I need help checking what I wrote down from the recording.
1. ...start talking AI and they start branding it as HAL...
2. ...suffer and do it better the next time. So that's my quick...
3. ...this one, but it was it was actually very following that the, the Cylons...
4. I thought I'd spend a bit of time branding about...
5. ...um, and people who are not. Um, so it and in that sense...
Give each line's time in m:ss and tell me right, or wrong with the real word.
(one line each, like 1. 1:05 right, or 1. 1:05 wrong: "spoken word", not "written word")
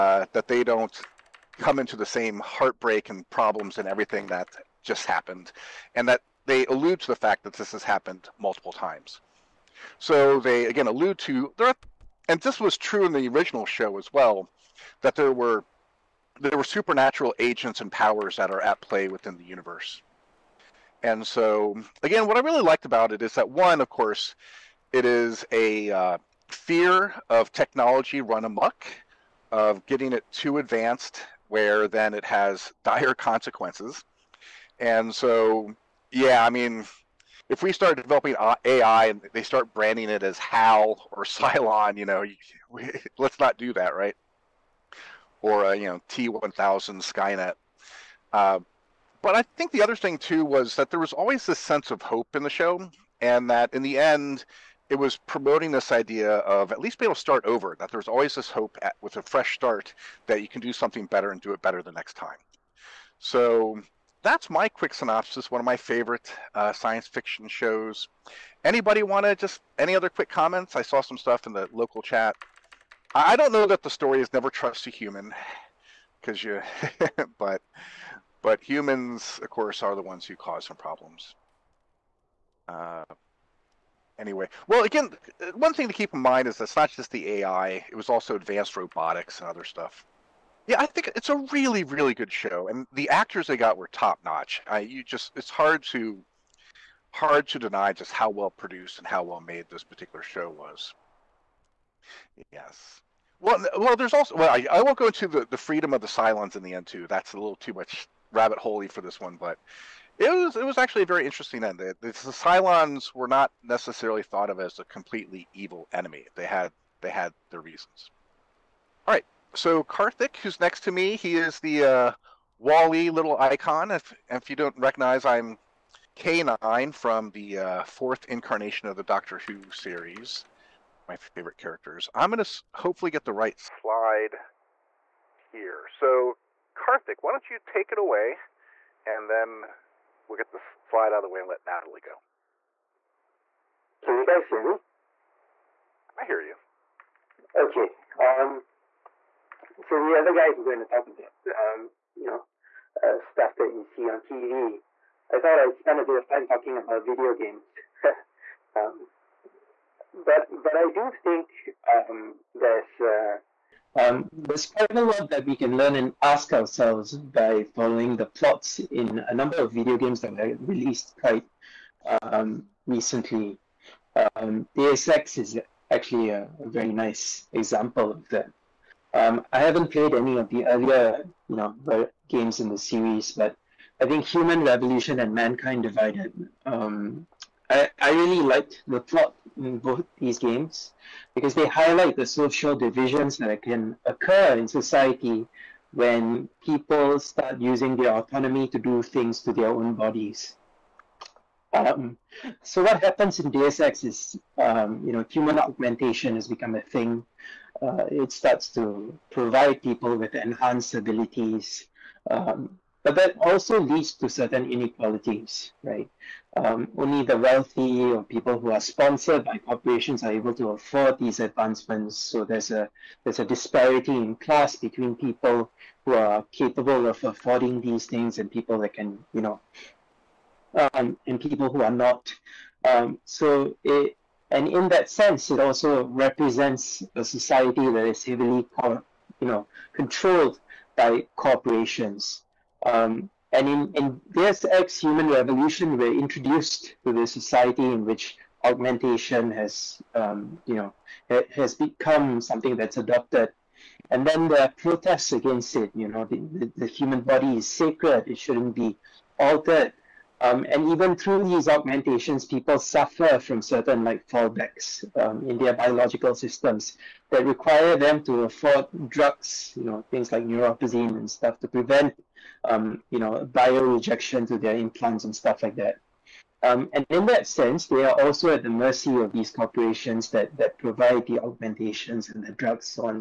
1. 0:37 wrong: "developing", not "talking"
2. 1:01 wrong: "better", not "suffer"
3. 1:49 wrong: "interesting", not "following"
4. 2:35 wrong: "talking", not "branding"
5. 3:50 right.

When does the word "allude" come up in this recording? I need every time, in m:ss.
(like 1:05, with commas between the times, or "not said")
0:06, 0:10.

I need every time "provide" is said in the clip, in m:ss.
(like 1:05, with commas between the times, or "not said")
3:29, 4:40.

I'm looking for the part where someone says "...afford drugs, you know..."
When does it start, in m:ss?
4:28.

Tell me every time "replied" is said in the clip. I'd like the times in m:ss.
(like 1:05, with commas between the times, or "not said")
not said.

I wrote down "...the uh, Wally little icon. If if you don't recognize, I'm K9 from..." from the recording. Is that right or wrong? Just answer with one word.
right.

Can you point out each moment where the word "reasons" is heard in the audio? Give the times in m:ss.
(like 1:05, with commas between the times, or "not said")
1:57.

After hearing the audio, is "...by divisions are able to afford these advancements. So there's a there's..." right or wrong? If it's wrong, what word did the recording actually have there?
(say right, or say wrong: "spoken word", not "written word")
wrong: "corporations", not "divisions".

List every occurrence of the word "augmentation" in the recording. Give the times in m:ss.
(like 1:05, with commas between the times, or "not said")
3:25, 4:08, 4:21, 4:41.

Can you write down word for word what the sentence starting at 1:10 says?
I saw some stuff in the local chat.